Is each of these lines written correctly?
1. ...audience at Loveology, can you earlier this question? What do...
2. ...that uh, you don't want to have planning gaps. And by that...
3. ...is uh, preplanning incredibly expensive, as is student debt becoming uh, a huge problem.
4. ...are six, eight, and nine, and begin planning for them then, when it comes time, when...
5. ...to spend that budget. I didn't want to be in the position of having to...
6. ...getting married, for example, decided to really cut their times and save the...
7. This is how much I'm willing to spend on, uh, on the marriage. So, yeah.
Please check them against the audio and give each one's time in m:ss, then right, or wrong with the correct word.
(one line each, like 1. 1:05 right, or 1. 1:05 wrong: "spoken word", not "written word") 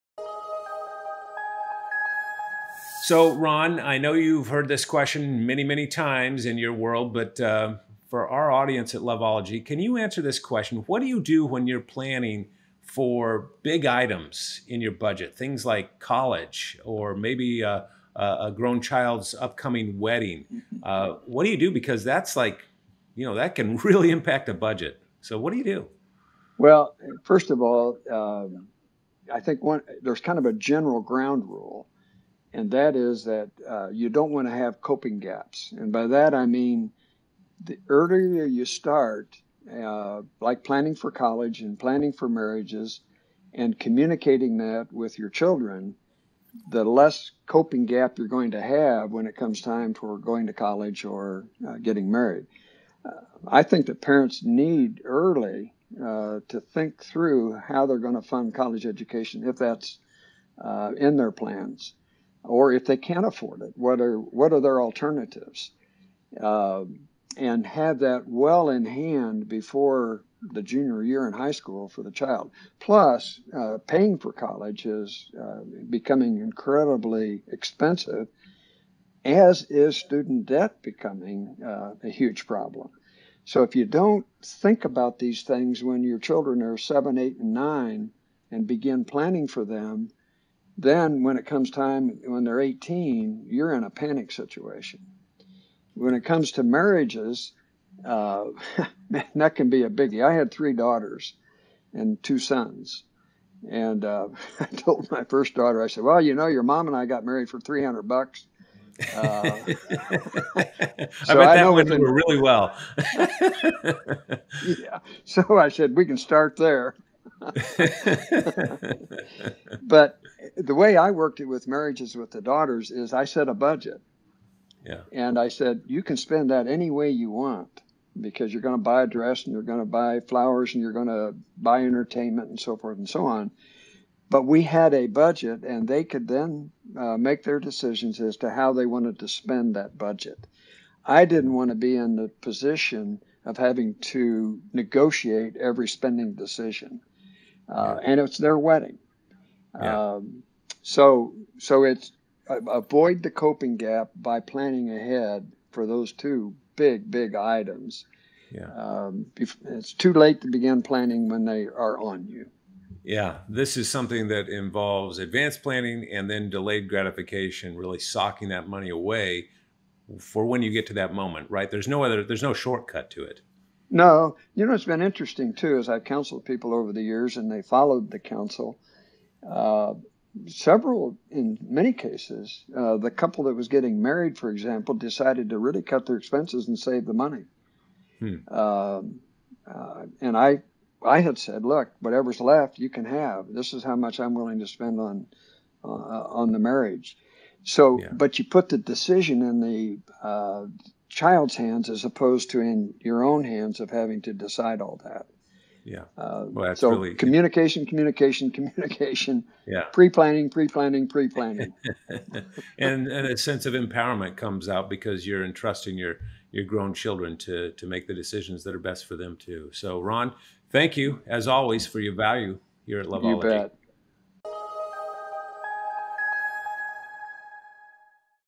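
1. 0:08 wrong: "answer", not "earlier"
2. 0:33 wrong: "coping", not "planning"
3. 1:14 wrong: "becoming", not "preplanning"
4. 1:26 wrong: "seven", not "six"
5. 2:19 right
6. 3:03 wrong: "expenses", not "times"
7. 3:13 right.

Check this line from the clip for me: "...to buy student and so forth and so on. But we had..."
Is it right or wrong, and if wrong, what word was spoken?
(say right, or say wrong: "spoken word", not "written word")
wrong: "entertainment", not "student".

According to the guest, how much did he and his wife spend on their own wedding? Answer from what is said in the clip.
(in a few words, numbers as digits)
$300.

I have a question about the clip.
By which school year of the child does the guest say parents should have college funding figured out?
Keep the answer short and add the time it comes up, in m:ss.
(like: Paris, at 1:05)
junior year, at 1:10.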